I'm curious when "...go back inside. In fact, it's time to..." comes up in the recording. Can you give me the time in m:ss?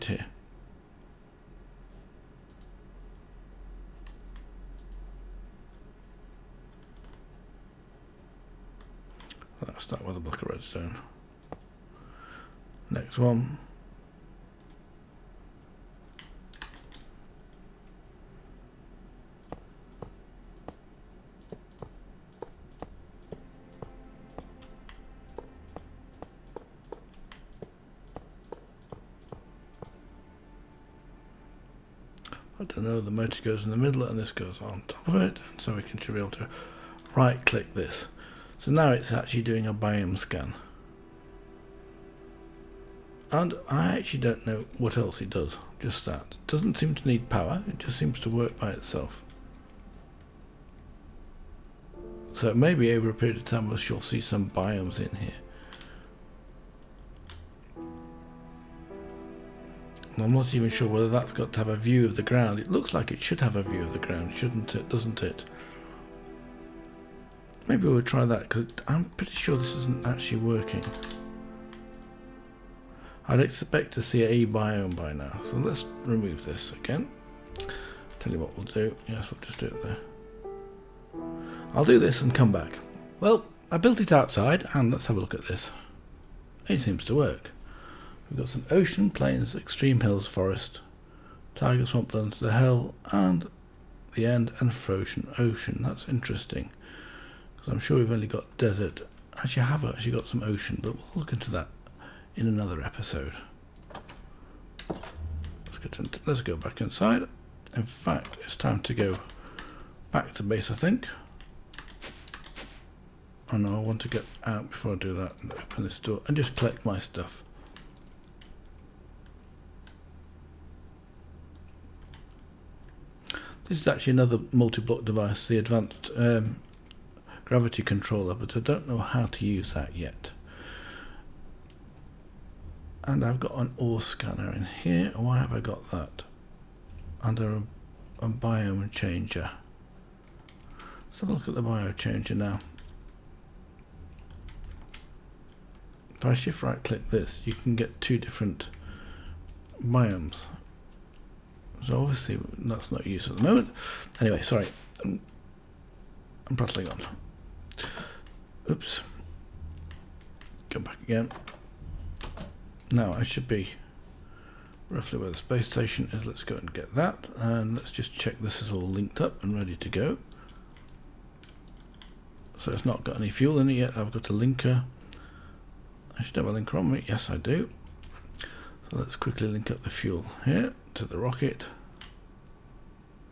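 1:46.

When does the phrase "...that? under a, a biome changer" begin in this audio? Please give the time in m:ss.
2:15.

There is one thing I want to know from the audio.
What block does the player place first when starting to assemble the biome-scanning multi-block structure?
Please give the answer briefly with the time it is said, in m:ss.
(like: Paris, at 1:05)
Block of redstone, at 0:10.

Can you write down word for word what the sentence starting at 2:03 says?
This is actually another multi-block device, the advanced um, gravity controller, but I don't know how to use that yet.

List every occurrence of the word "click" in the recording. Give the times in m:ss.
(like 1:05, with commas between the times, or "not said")
0:37, 2:26.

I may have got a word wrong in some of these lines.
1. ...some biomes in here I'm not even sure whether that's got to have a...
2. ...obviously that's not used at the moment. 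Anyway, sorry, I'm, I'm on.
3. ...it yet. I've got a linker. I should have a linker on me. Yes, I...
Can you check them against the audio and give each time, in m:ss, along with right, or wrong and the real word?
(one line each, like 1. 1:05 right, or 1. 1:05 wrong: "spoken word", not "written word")
1. 0:54 right
2. 2:31 right
3. 2:53 right.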